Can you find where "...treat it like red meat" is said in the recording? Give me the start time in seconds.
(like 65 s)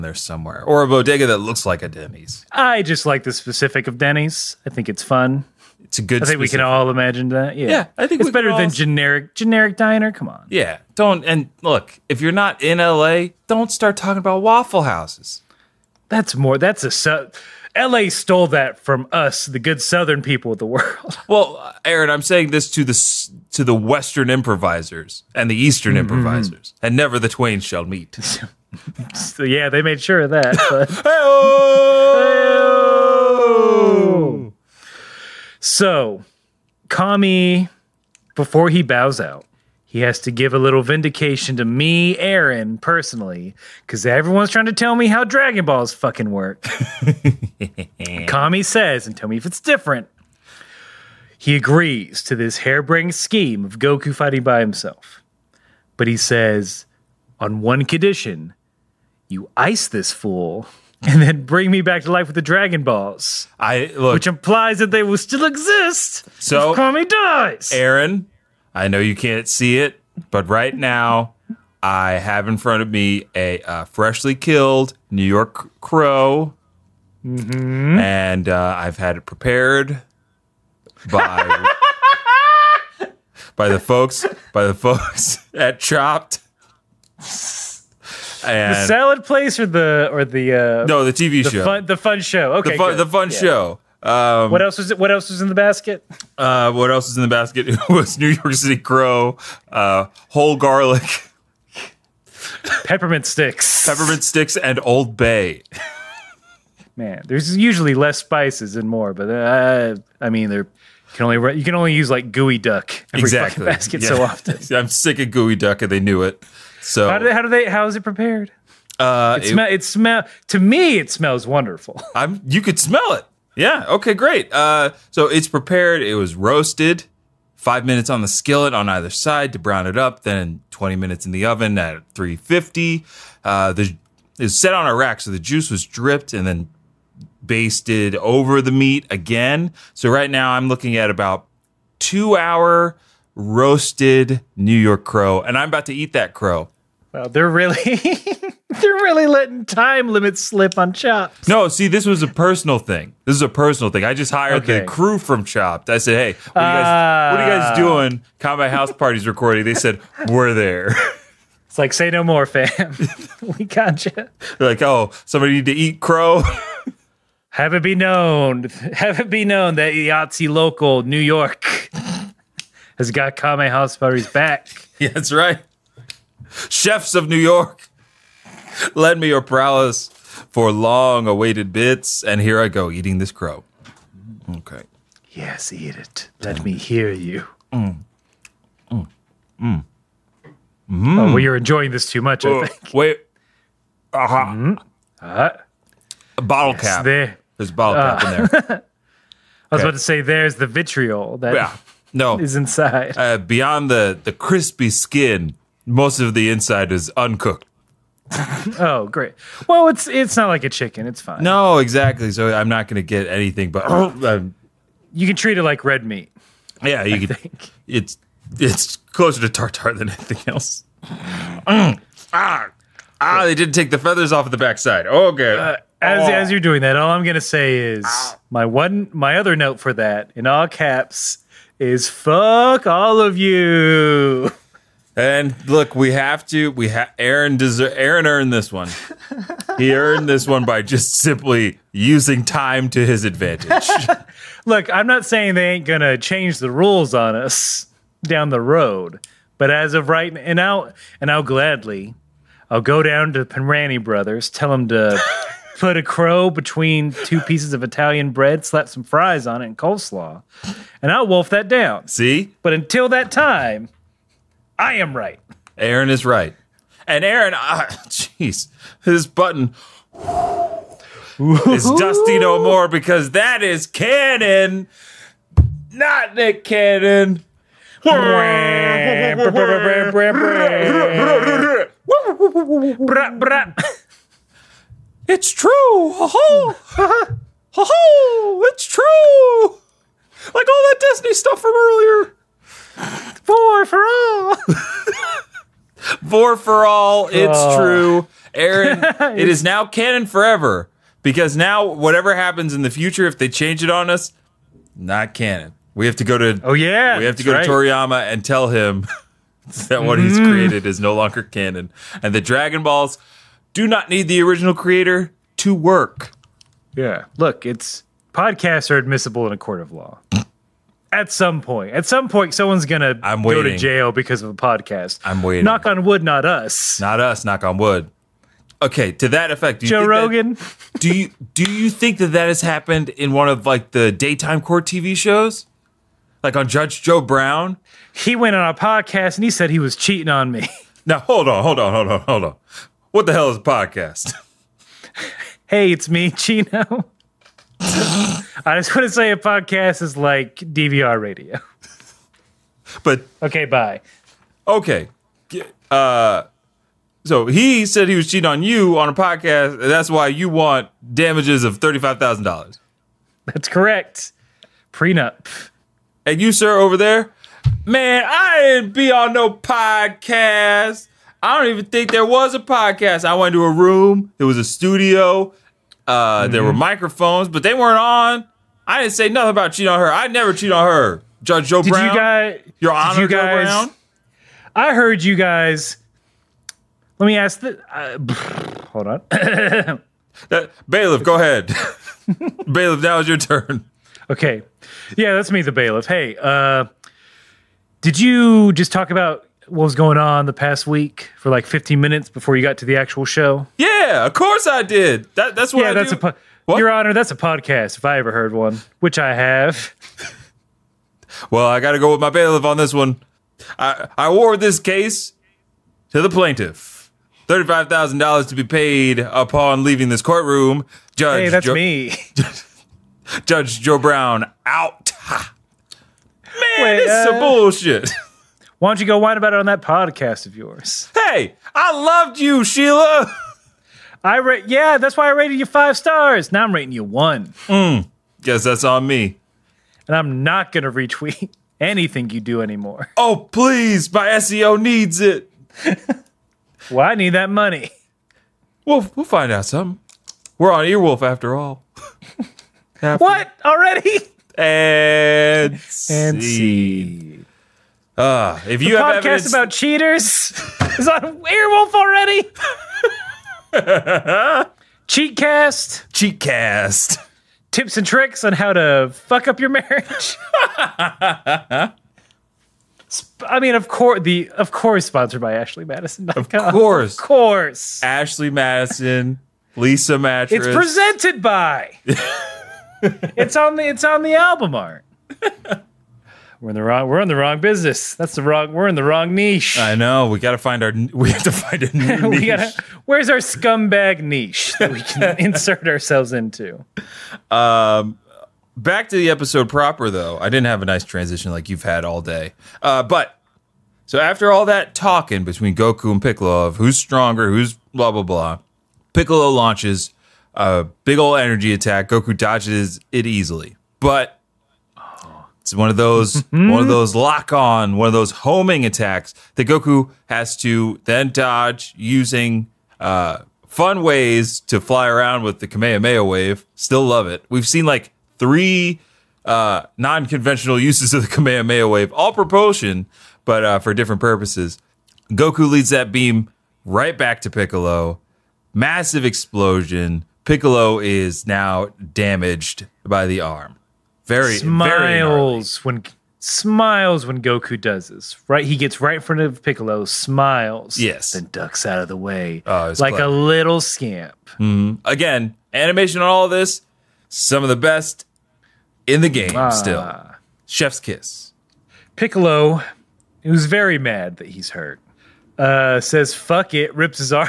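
215 s.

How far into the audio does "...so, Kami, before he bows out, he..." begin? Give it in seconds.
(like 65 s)
35 s.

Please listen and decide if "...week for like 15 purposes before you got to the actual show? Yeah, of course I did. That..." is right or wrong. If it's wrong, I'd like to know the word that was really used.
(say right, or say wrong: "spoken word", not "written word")
wrong: "minutes", not "purposes".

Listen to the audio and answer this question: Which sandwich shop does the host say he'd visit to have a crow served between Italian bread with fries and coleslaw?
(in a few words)
Penrani Brothers.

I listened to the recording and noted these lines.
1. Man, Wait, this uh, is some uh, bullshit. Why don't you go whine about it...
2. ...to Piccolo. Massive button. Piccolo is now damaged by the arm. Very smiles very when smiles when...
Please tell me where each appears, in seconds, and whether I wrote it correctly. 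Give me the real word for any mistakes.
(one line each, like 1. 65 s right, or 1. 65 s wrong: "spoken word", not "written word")
1. 425 s right
2. 537 s wrong: "explosion", not "button".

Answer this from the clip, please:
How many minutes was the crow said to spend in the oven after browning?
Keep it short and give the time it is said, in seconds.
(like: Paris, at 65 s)
20, at 130 s.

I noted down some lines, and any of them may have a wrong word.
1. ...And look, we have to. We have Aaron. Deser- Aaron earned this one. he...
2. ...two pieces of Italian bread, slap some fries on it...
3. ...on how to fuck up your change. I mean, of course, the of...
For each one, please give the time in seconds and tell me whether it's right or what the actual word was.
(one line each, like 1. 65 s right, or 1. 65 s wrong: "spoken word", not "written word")
1. 235 s right
2. 257 s right
3. 468 s wrong: "marriage", not "change".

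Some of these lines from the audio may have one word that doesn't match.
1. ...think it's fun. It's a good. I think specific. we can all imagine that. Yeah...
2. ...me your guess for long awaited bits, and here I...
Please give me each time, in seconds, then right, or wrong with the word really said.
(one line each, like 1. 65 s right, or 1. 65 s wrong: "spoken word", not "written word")
1. 4 s right
2. 179 s wrong: "prowess", not "guess".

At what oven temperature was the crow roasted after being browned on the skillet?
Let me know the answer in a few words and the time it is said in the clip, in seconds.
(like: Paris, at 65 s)
350, at 132 s.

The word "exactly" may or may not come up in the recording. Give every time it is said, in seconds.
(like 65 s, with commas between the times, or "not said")
113 s, 211 s.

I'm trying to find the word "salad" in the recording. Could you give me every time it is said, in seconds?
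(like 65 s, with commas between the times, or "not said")
88 s.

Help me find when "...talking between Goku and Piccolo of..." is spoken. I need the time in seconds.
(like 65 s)
504 s.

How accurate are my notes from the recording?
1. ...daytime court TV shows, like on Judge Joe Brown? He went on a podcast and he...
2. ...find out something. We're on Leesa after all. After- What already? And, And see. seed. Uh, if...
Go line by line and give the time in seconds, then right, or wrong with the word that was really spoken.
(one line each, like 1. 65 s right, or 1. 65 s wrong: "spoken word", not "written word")
1. 334 s right
2. 449 s wrong: "Earwolf", not "Leesa".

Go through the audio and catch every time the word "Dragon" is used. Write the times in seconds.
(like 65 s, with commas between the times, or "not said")
45 s, 62 s, 312 s.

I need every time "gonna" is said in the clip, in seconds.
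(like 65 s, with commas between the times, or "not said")
245 s, 322 s, 440 s.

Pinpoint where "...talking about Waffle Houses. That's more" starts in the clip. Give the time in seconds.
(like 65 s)
13 s.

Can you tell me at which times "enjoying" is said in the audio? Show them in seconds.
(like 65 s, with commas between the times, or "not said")
191 s.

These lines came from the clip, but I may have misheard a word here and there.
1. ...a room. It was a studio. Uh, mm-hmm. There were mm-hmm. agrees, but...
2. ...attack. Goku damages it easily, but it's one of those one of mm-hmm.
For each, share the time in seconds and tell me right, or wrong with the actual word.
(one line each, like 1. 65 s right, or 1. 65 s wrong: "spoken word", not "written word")
1. 373 s wrong: "microphones", not "agrees"
2. 511 s wrong: "dodges", not "damages".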